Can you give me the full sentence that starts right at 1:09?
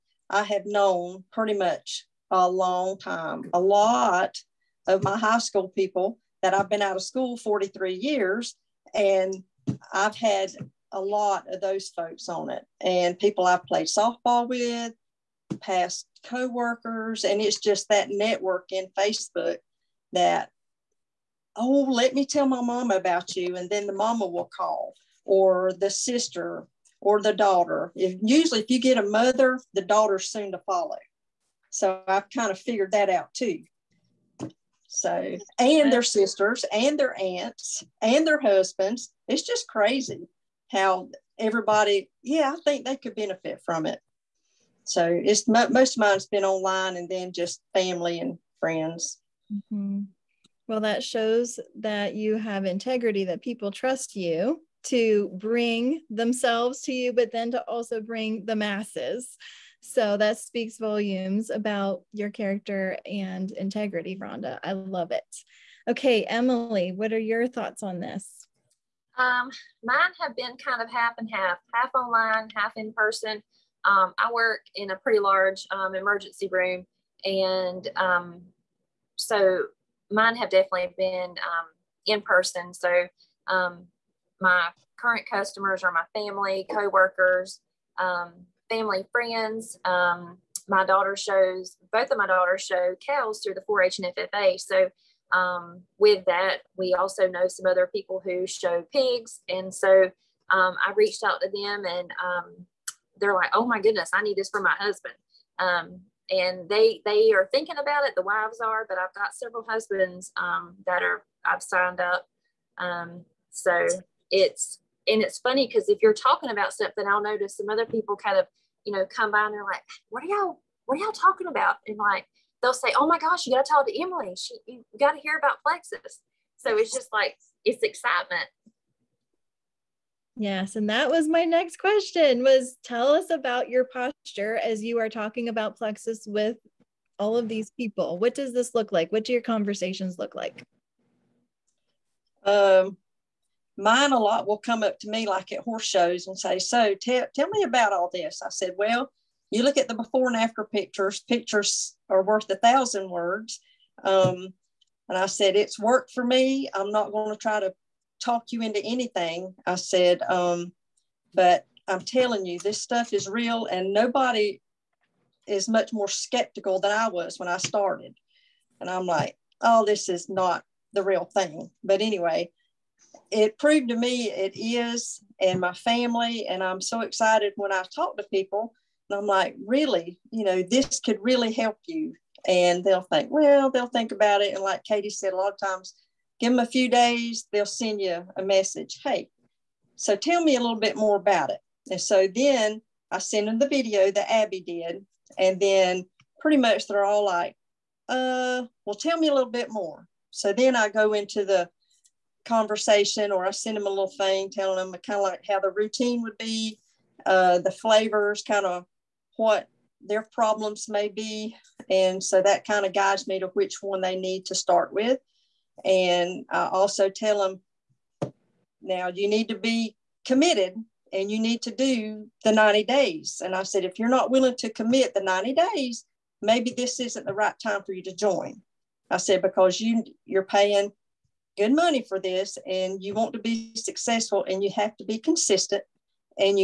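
Um, mine have been kind of half and half, half online, half in person.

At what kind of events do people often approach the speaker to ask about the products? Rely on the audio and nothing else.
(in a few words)
horse shows.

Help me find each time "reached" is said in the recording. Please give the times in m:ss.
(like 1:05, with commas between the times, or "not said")
1:40.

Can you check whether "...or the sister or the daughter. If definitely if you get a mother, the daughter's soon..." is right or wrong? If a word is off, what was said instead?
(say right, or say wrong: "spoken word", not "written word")
wrong: "usually", not "definitely".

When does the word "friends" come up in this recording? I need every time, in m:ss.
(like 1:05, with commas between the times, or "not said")
0:48, 1:29.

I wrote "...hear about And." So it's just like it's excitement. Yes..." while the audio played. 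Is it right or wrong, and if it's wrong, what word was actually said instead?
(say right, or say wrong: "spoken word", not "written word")
wrong: "Plexus", not "And".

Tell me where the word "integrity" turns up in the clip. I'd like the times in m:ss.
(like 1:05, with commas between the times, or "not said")
0:52, 1:03.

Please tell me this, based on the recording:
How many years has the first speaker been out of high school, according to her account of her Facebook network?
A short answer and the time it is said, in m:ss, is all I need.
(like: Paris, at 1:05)
43, at 0:07.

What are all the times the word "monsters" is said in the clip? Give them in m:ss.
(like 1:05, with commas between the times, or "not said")
not said.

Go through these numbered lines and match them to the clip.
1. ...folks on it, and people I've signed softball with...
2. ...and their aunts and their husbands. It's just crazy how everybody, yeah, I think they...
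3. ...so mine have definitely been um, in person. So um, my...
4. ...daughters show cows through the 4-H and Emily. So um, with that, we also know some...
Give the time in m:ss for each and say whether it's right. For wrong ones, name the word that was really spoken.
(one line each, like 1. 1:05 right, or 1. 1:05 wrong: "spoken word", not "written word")
1. 0:11 wrong: "played", not "signed"
2. 0:36 right
3. 1:19 right
4. 1:32 wrong: "FFA", not "Emily".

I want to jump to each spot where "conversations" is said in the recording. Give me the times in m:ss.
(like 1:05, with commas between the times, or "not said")
2:19, 3:22.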